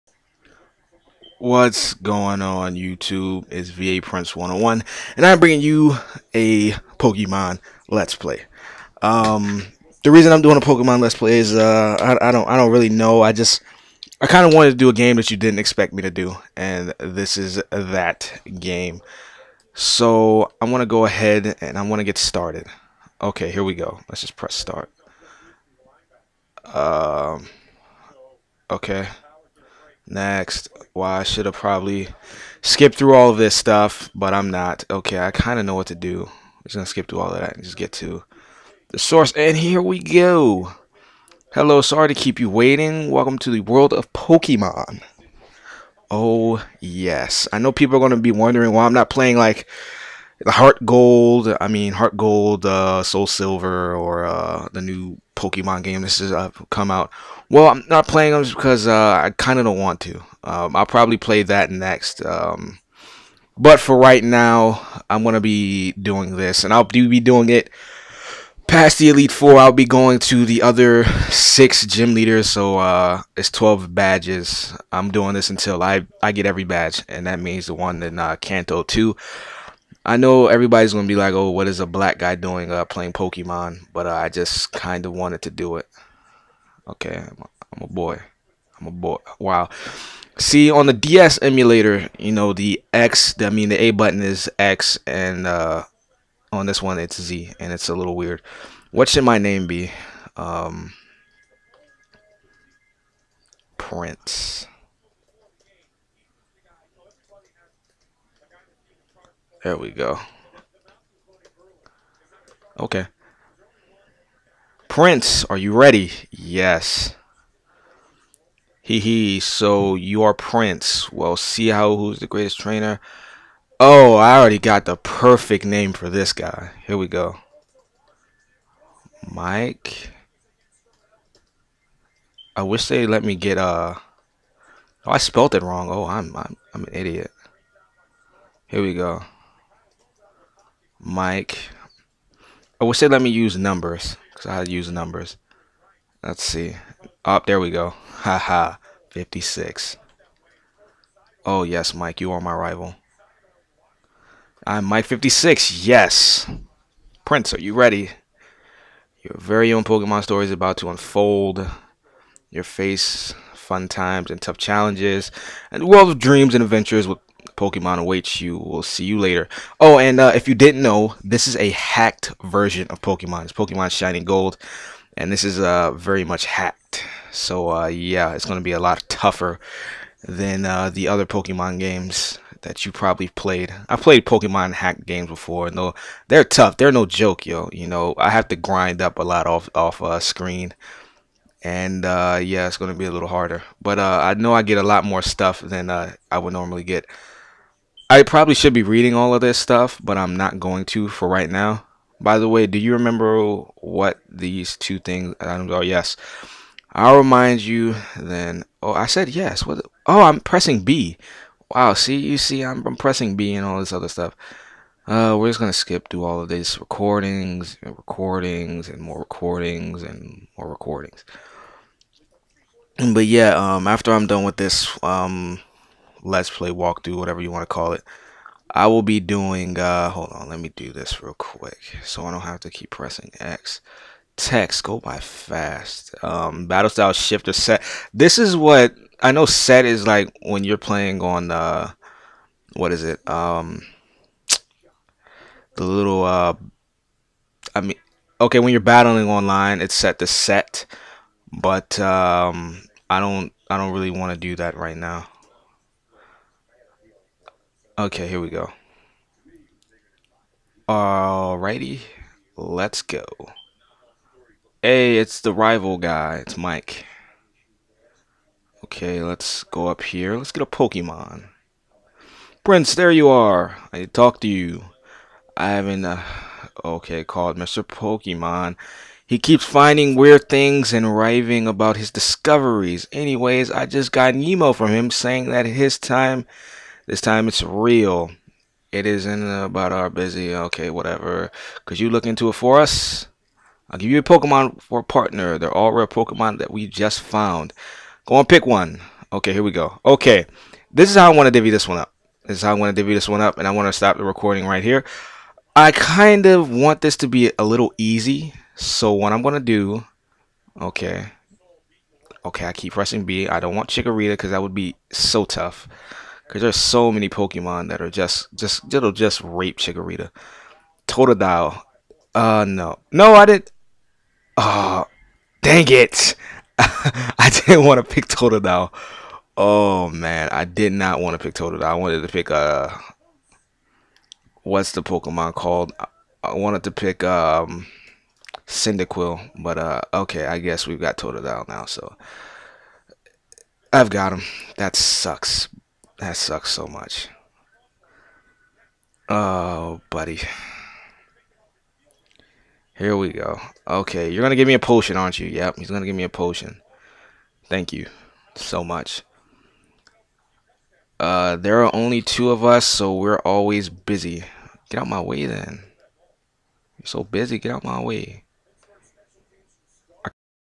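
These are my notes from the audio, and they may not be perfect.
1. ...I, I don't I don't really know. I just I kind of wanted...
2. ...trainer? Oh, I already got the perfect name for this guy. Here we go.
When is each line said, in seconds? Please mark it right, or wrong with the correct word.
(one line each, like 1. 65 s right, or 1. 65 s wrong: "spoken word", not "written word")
1. 11 s right
2. 122 s right.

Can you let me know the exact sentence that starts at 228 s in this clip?
I will be doing, uh, hold on, let me do this real quick so I don't have to keep pressing X.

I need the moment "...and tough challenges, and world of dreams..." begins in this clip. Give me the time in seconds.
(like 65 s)
164 s.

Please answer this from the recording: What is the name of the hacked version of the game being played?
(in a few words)
Pokemon Shining Gold.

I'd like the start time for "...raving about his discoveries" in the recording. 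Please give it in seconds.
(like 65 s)
281 s.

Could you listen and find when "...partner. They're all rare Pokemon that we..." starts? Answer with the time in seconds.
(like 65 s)
295 s.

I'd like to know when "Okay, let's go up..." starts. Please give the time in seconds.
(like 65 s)
268 s.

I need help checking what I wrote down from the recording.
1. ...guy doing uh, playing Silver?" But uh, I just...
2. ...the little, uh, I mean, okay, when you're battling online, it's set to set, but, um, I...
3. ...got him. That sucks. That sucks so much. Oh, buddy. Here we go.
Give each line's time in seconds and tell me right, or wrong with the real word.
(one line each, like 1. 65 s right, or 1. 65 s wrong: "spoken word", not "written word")
1. 82 s wrong: "Pokemon", not "Silver"
2. 245 s right
3. 344 s right.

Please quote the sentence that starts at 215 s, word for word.
Uh, we're just gonna skip through all of these recordings and recordings and more recordings and more recordings.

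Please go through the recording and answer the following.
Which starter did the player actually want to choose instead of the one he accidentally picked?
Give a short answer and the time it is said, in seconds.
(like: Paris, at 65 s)
Cyndaquil, at 338 s.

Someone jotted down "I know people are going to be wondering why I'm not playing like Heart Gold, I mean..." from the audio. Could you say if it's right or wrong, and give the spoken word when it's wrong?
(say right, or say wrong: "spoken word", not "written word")
right.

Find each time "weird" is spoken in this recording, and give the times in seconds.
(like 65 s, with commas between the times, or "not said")
98 s, 280 s.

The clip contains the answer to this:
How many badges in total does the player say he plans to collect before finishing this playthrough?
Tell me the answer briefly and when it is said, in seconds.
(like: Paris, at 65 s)
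12, at 73 s.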